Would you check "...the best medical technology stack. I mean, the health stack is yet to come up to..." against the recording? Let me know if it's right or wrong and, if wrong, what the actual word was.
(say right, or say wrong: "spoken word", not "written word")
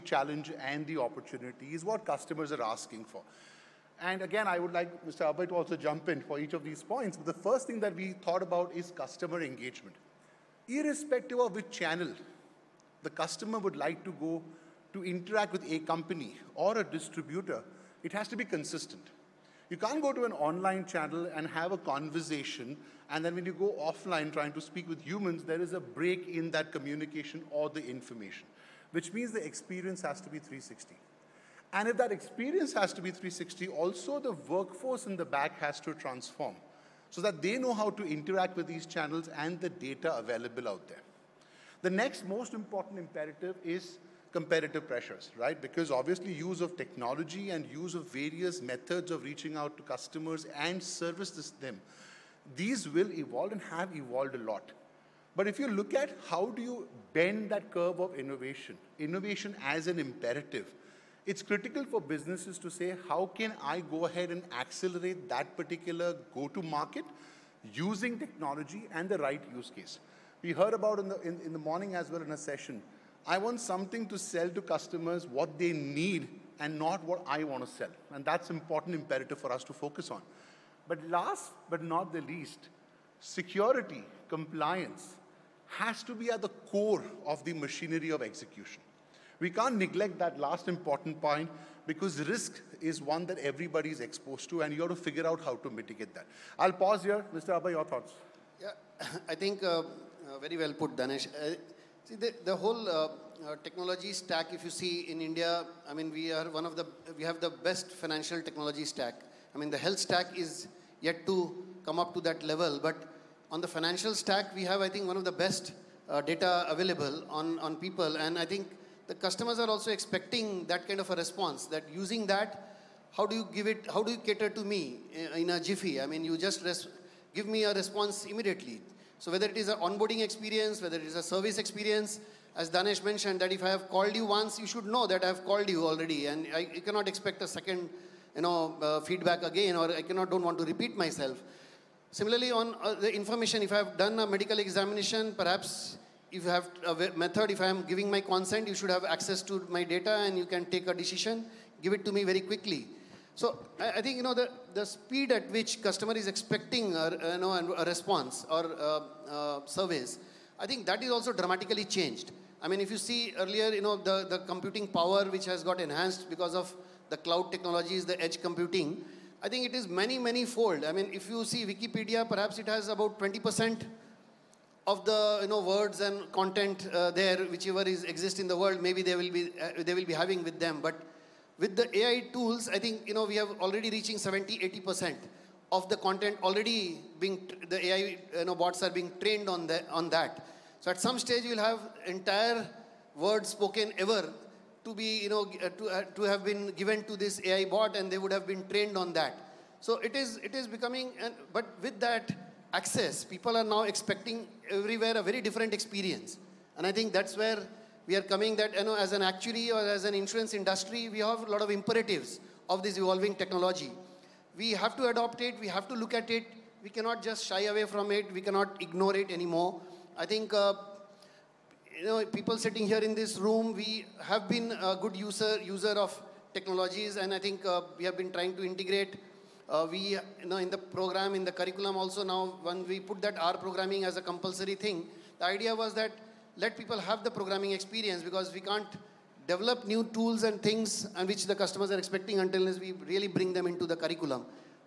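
wrong: "financial", not "medical".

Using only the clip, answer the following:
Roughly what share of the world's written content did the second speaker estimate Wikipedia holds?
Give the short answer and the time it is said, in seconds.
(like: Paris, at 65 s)
20 percent, at 173 s.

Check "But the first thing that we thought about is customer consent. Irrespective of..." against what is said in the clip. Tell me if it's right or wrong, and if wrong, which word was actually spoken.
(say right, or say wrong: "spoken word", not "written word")
wrong: "engagement", not "consent".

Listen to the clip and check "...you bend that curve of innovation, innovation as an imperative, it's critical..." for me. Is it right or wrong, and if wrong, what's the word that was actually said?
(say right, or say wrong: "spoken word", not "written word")
right.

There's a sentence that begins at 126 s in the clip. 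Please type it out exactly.
I mean, you just give me a response immediately.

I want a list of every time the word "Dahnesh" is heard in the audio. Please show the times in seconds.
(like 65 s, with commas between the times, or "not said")
100 s, 132 s.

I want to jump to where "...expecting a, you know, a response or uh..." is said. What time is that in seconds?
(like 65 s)
156 s.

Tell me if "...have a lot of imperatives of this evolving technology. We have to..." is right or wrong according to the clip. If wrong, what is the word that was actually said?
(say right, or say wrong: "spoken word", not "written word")
right.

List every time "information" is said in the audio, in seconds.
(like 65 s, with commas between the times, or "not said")
27 s, 143 s.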